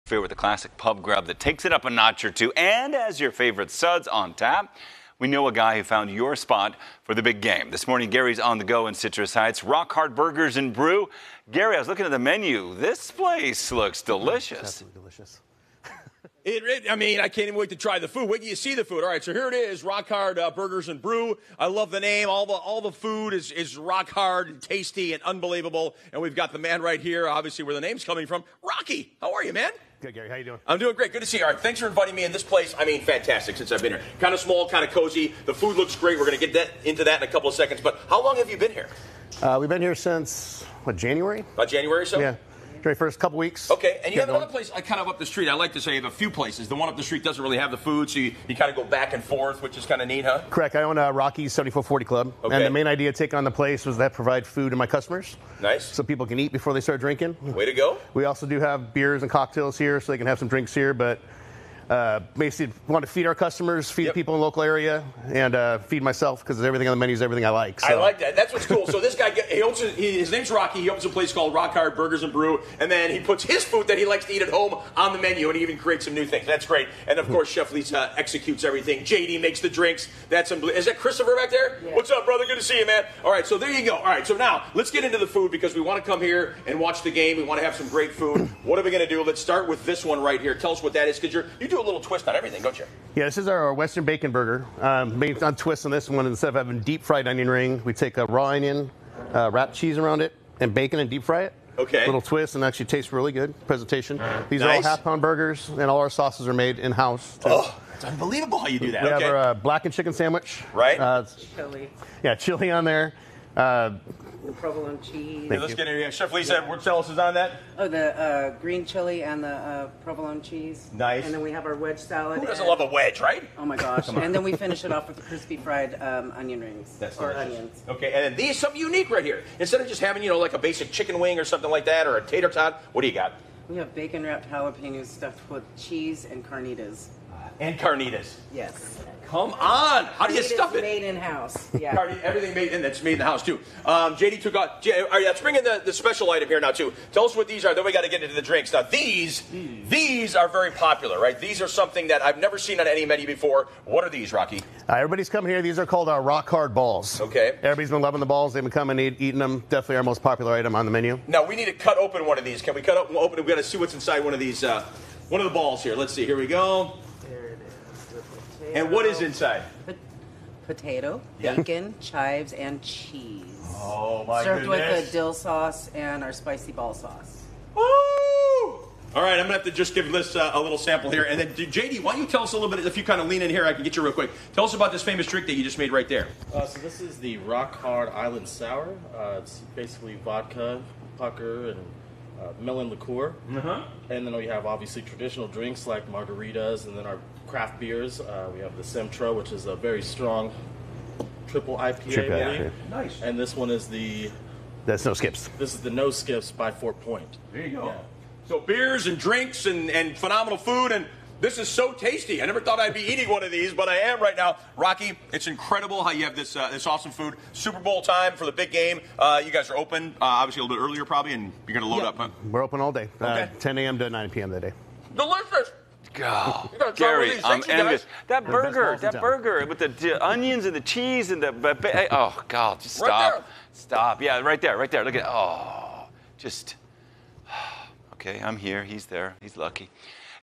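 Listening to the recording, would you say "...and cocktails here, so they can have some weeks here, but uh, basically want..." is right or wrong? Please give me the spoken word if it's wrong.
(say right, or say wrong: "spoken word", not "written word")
wrong: "drinks", not "weeks".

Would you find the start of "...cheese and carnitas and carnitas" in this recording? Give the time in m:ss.
2:15.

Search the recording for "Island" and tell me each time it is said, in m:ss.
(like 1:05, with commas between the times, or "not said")
3:08.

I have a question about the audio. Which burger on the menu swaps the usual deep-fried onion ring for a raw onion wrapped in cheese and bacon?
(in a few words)
Western Bacon Burger.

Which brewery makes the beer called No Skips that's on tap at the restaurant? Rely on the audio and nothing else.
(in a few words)
Fort Point.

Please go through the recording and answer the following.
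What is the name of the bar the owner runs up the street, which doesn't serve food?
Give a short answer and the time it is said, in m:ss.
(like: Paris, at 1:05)
Rocky's 7440 Club, at 0:51.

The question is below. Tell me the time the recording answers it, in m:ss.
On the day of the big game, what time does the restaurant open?
3:43.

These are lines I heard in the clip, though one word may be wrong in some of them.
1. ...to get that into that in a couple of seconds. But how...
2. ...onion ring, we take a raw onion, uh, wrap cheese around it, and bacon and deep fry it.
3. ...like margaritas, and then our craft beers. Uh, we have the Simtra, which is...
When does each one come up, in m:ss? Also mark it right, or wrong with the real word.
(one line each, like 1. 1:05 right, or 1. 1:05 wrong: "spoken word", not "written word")
1. 0:36 right
2. 1:37 right
3. 3:15 right.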